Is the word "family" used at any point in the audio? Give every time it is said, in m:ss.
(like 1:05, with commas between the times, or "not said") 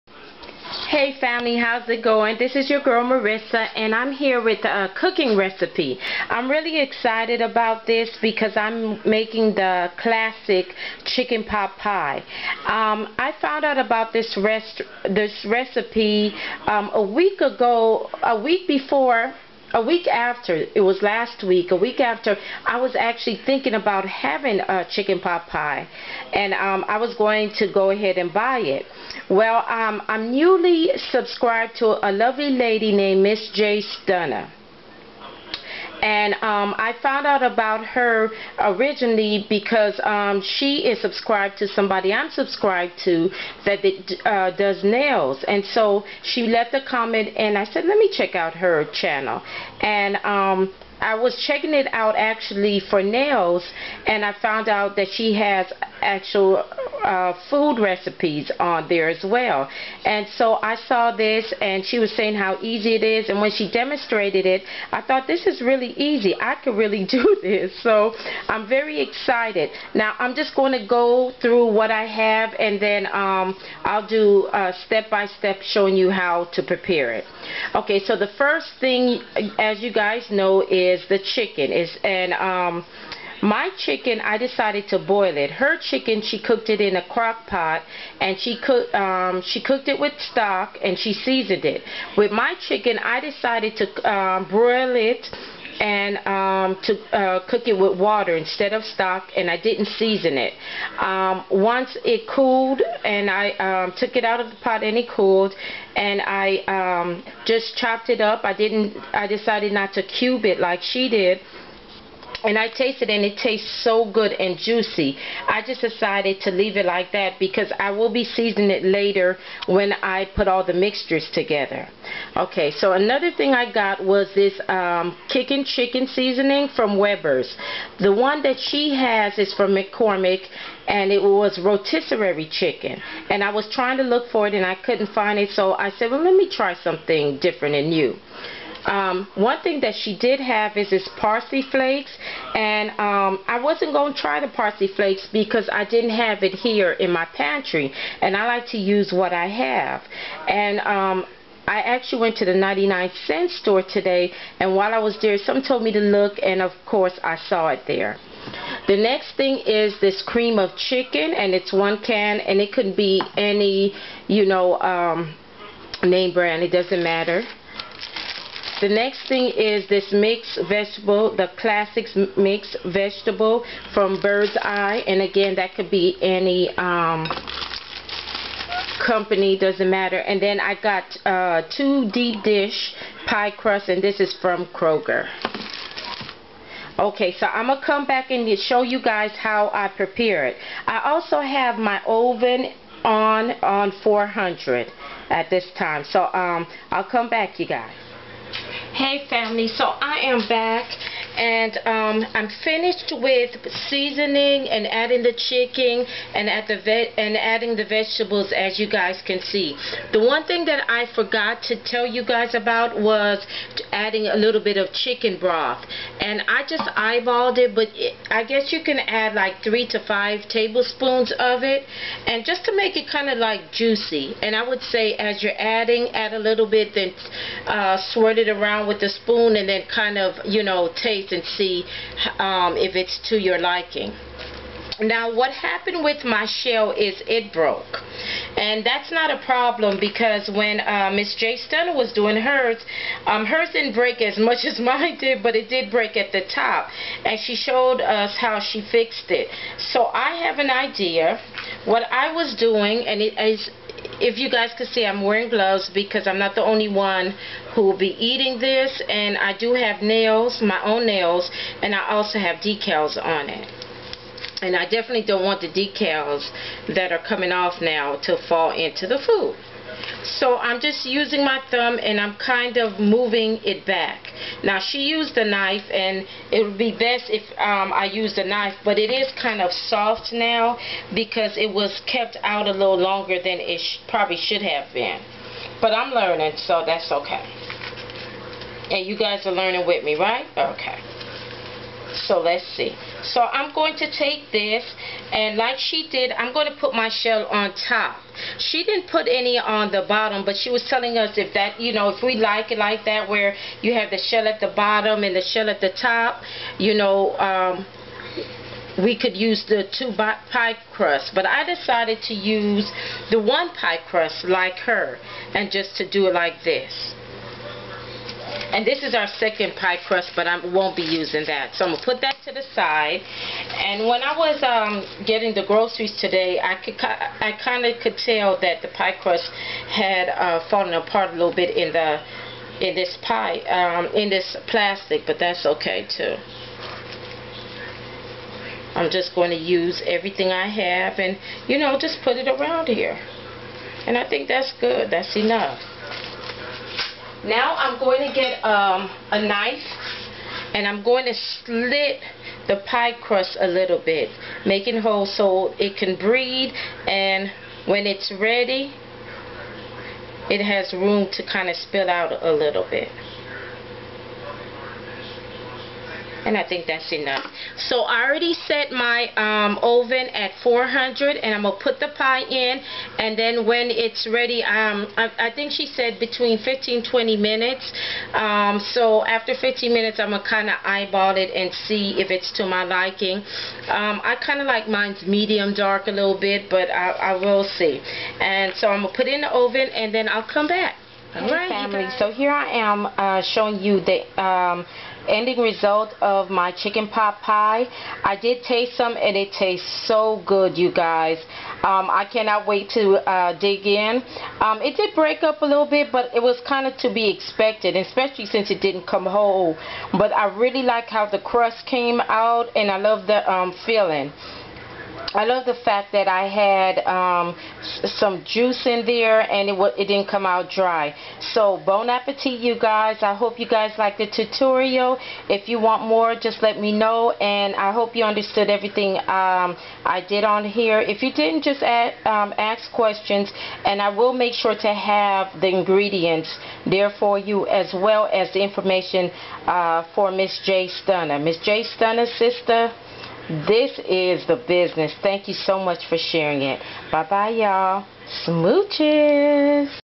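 0:01, 3:19, 6:31.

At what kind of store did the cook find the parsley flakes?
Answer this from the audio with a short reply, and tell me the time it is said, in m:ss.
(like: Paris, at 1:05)
99 cent store, at 2:32.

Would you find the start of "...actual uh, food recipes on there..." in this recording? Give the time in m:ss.
0:56.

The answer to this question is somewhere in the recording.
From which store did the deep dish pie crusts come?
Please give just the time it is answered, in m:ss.
3:04.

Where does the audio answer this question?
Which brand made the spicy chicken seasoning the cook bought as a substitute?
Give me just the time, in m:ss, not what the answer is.
2:06.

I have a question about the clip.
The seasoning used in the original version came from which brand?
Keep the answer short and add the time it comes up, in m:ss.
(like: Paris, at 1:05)
McCormick, at 2:09.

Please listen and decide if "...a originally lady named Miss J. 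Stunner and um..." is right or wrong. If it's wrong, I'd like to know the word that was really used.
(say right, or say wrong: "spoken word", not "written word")
wrong: "lovely", not "originally".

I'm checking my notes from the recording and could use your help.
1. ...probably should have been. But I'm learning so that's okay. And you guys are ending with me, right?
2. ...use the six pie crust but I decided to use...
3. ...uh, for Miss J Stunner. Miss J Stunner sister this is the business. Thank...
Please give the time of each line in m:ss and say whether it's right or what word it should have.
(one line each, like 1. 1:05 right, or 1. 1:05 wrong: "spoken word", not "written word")
1. 4:44 wrong: "learning", not "ending"
2. 5:09 wrong: "two", not "six"
3. 7:19 right.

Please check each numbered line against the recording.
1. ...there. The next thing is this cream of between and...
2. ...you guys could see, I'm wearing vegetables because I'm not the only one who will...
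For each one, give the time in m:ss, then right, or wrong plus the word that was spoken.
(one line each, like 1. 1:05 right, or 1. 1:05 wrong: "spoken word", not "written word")
1. 2:37 wrong: "chicken", not "between"
2. 4:14 wrong: "gloves", not "vegetables".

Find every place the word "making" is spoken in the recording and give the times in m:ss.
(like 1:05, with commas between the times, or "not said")
0:09, 5:54.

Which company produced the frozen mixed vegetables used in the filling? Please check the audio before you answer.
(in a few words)
Bird's Eye.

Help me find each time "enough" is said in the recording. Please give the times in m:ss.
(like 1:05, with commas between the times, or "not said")
5:45, 6:07.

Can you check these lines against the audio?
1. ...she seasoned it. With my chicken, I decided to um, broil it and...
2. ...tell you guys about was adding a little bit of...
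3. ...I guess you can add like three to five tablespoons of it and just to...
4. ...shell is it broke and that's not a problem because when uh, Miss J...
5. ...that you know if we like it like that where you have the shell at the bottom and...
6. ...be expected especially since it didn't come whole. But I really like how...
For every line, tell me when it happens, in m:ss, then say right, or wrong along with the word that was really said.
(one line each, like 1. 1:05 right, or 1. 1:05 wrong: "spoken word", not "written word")
1. 1:30 right
2. 3:31 right
3. 3:38 right
4. 3:56 right
5. 5:01 right
6. 6:47 right.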